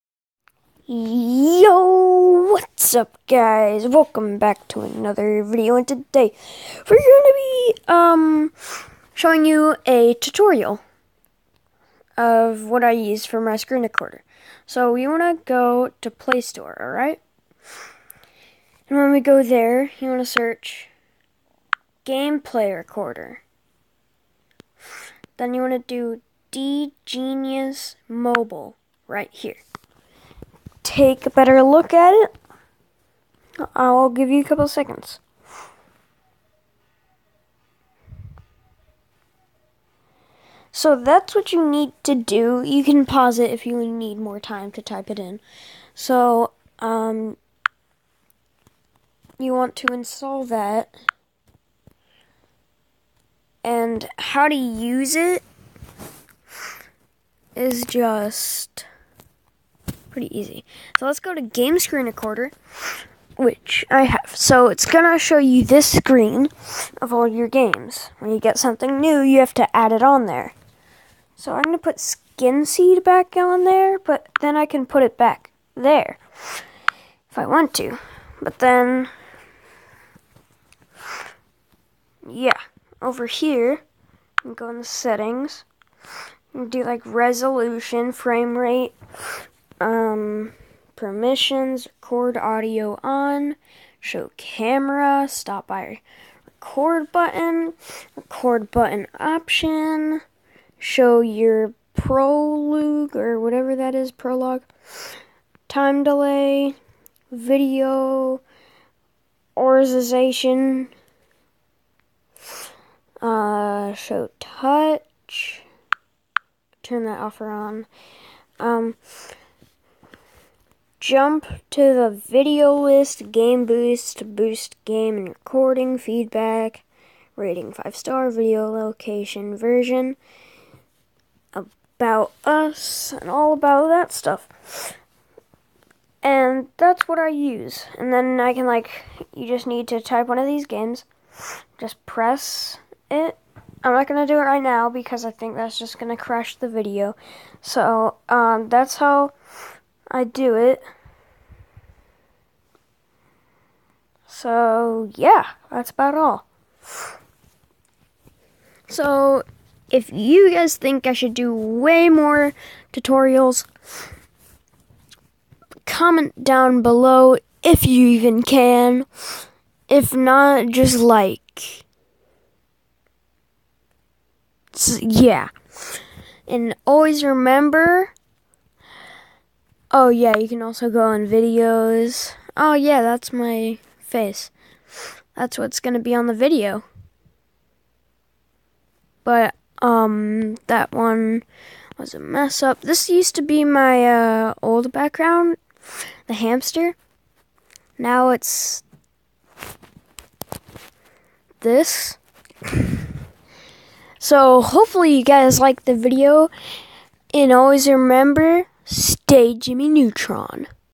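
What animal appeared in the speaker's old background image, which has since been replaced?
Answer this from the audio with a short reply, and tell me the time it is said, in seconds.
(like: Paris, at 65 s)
hamster, at 196 s.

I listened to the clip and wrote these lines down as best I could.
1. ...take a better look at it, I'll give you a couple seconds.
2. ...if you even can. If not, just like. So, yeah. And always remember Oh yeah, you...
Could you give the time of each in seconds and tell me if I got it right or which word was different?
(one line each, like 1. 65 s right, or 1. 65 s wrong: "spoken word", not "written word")
1. 30 s right
2. 167 s right.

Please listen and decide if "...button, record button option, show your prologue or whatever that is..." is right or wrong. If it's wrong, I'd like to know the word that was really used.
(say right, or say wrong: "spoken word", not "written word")
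right.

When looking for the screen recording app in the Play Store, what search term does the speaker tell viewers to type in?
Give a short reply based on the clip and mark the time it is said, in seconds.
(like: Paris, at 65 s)
gameplay recorder, at 22 s.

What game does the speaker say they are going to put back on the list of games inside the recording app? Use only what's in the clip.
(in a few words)
Skinseed.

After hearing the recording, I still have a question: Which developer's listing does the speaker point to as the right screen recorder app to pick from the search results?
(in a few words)
D Genius Mobile.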